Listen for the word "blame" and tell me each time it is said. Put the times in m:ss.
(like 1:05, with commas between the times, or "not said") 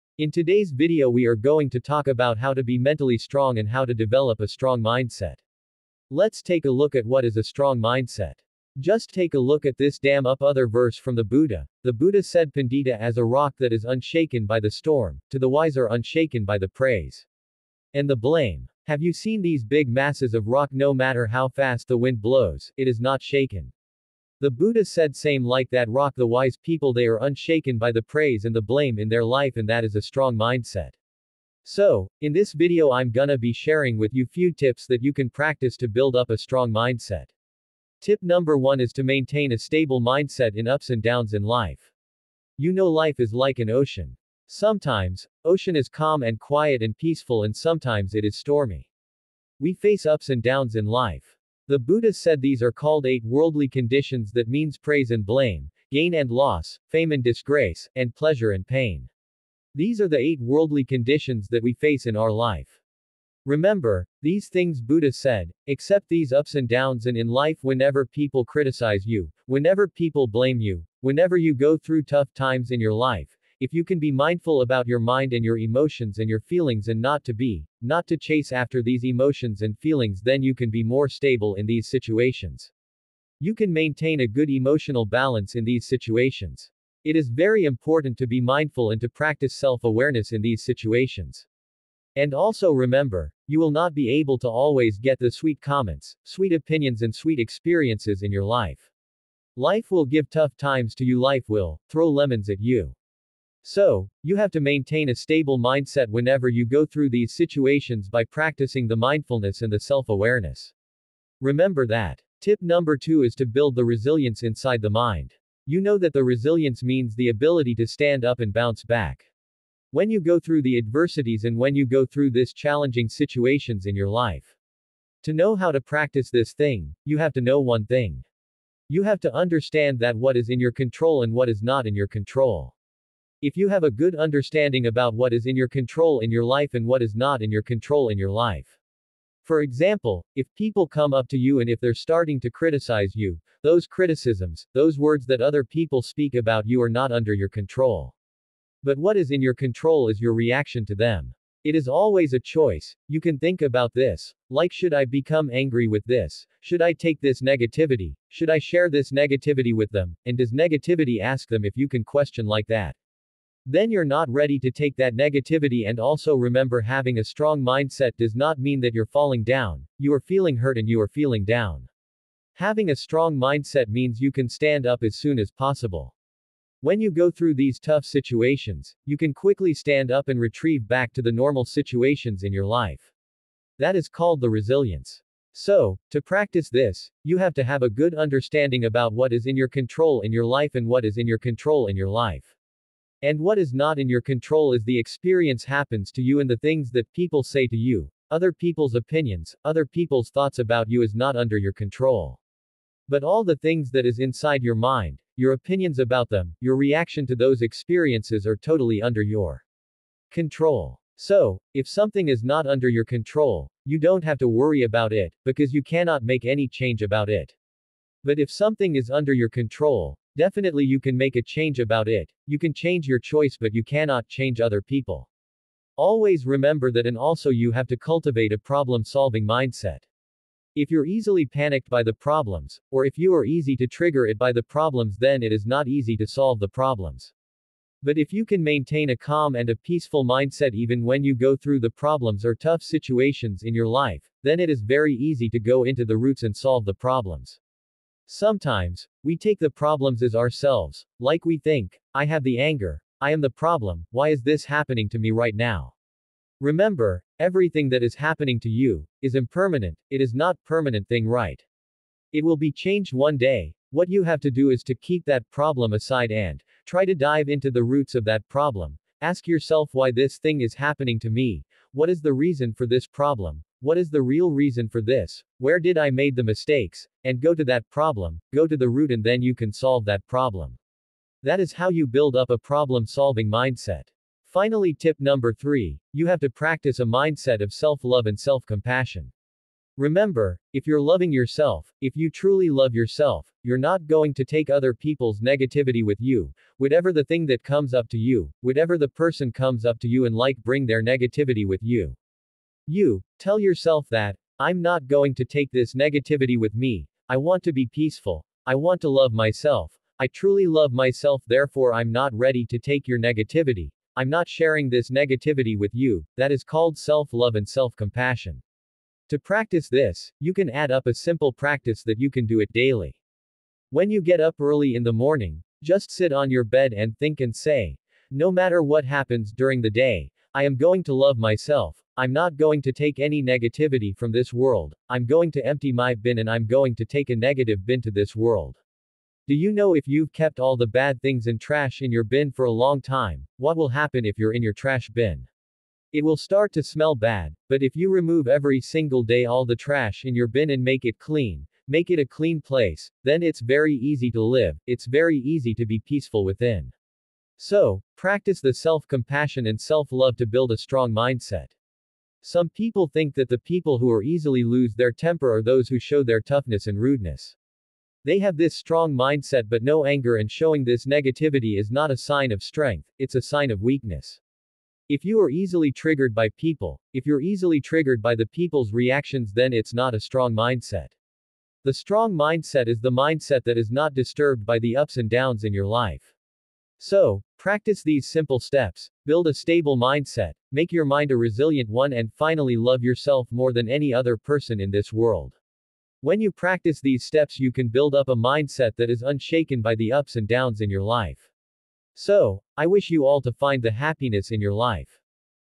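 0:18, 0:28, 0:55, 1:10.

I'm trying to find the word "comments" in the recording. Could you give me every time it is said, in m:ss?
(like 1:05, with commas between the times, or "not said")
1:35.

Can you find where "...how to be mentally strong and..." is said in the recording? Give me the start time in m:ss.
0:02.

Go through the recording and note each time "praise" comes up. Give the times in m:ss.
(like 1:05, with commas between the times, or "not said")
0:16, 0:28, 0:54.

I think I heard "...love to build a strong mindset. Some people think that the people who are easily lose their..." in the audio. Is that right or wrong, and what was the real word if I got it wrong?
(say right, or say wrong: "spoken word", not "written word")
right.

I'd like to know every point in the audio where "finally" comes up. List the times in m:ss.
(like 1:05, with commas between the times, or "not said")
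4:44, 6:32.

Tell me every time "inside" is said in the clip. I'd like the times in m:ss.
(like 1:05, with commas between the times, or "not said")
1:54, 3:24.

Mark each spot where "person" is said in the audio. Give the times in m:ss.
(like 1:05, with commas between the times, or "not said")
4:59, 6:34.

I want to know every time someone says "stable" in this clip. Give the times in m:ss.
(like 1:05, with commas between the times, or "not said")
0:39, 1:21, 1:45, 6:29.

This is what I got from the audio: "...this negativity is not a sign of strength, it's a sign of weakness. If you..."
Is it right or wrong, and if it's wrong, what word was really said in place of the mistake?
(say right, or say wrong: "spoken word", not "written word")
right.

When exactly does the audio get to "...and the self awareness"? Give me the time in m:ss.
1:49.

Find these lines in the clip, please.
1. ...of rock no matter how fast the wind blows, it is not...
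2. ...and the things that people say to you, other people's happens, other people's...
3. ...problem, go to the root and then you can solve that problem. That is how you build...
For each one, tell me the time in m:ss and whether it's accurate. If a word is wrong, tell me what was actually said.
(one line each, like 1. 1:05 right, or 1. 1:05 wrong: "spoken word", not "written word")
1. 0:20 right
2. 3:16 wrong: "opinions", not "happens"
3. 4:37 right.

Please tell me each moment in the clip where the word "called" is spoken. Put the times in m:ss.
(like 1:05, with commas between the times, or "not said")
0:52, 3:04, 5:16.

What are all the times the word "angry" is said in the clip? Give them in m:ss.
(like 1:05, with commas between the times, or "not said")
2:35.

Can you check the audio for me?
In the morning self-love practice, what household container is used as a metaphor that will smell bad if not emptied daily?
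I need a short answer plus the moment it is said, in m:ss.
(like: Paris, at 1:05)
trash bin, at 5:44.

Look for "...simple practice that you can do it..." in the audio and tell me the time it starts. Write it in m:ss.
5:21.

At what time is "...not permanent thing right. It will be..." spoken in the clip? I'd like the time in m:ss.
4:20.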